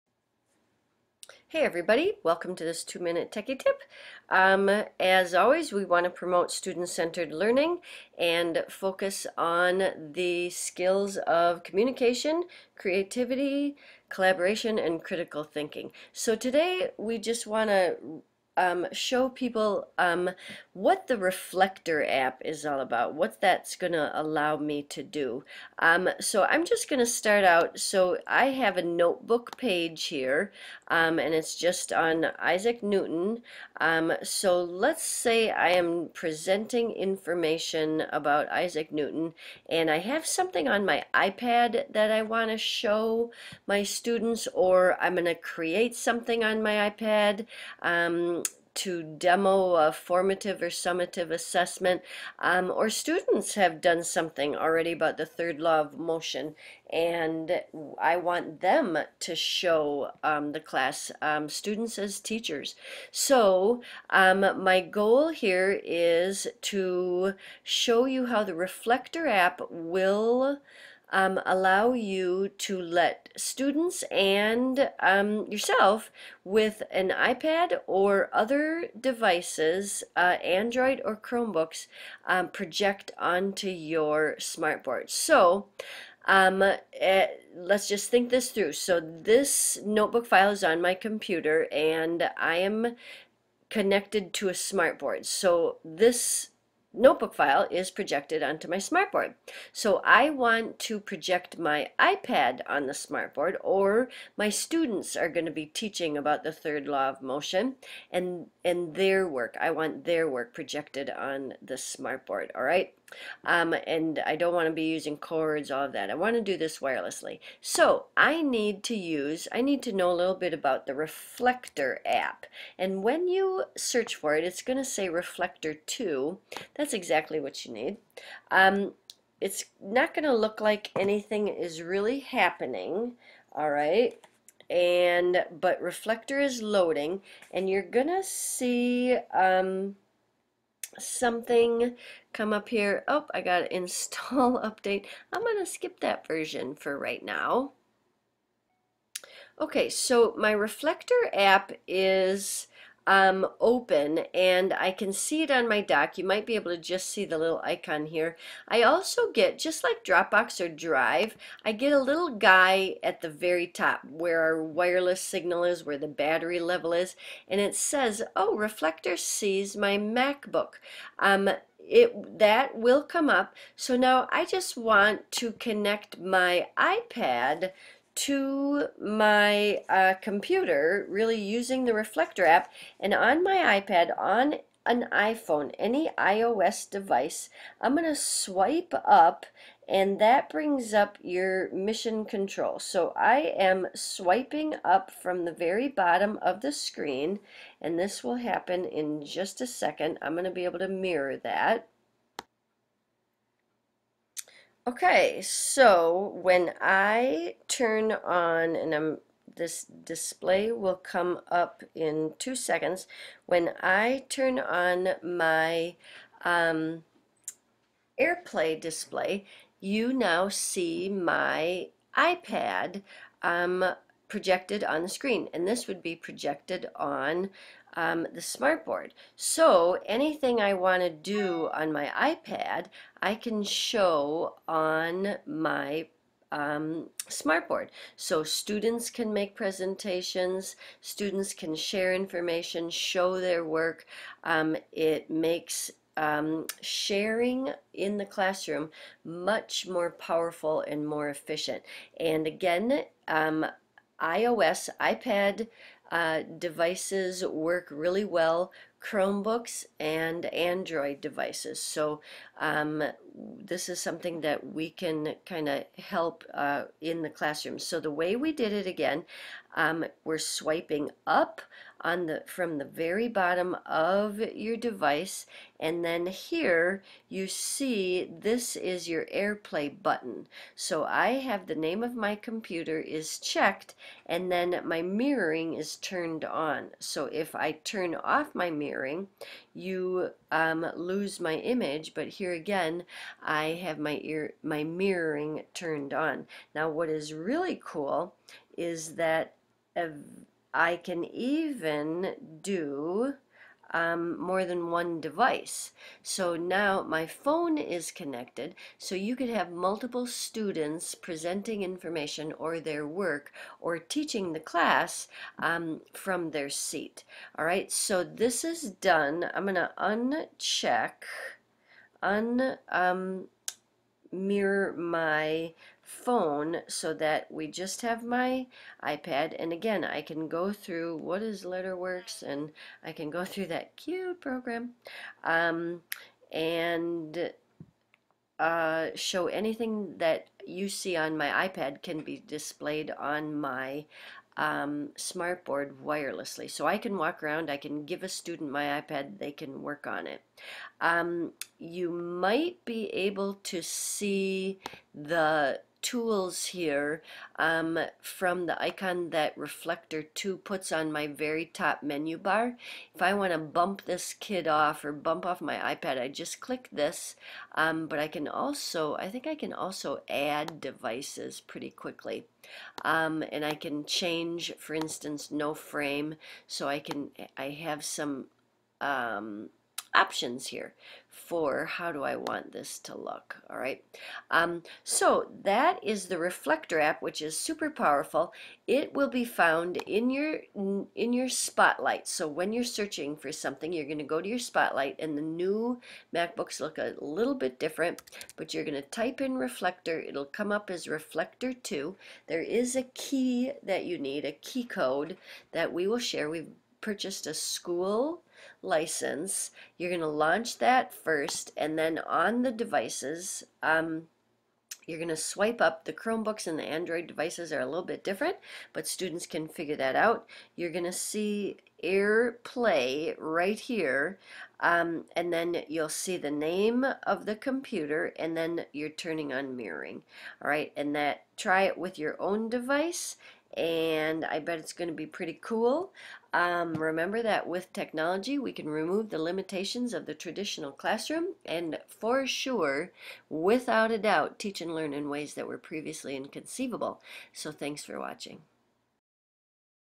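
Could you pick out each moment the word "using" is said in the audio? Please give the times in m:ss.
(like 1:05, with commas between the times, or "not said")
1:54, 3:01.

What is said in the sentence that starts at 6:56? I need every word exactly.
The Chromebooks and the Android devices are a little bit different, but students can figure that out.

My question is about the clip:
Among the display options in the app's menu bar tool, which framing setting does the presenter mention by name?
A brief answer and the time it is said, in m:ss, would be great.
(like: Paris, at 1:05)
no frame, at 6:15.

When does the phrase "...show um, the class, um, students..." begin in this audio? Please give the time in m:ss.
0:59.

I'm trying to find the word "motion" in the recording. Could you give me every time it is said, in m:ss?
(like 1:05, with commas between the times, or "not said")
0:55, 1:47.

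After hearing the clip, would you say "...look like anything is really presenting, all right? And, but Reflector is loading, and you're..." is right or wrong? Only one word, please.
wrong.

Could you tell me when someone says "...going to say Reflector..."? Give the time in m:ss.
2:04.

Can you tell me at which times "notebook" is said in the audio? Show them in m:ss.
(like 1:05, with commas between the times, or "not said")
0:28, 1:29, 1:36.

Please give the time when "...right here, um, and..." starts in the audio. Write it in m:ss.
7:03.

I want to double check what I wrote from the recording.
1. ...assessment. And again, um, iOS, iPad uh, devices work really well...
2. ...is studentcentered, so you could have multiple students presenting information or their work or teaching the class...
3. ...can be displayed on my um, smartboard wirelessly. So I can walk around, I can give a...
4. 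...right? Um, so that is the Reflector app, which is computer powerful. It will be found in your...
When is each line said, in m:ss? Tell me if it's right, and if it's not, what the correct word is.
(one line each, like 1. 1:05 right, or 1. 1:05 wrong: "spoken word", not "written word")
1. 4:11 wrong: "efficient", not "assessment"
2. 5:07 wrong: "connected", not "studentcentered"
3. 5:42 right
4. 6:23 wrong: "super", not "computer".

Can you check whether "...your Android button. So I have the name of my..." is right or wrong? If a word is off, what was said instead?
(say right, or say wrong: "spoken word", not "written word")
wrong: "AirPlay", not "Android".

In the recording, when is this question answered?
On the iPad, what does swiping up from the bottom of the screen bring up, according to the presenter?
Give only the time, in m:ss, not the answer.
3:11.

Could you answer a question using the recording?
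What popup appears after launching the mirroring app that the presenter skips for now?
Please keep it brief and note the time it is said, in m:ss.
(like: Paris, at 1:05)
install update, at 2:23.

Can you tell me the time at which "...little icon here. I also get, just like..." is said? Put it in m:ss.
2:37.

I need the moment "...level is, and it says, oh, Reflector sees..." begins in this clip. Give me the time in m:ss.
2:46.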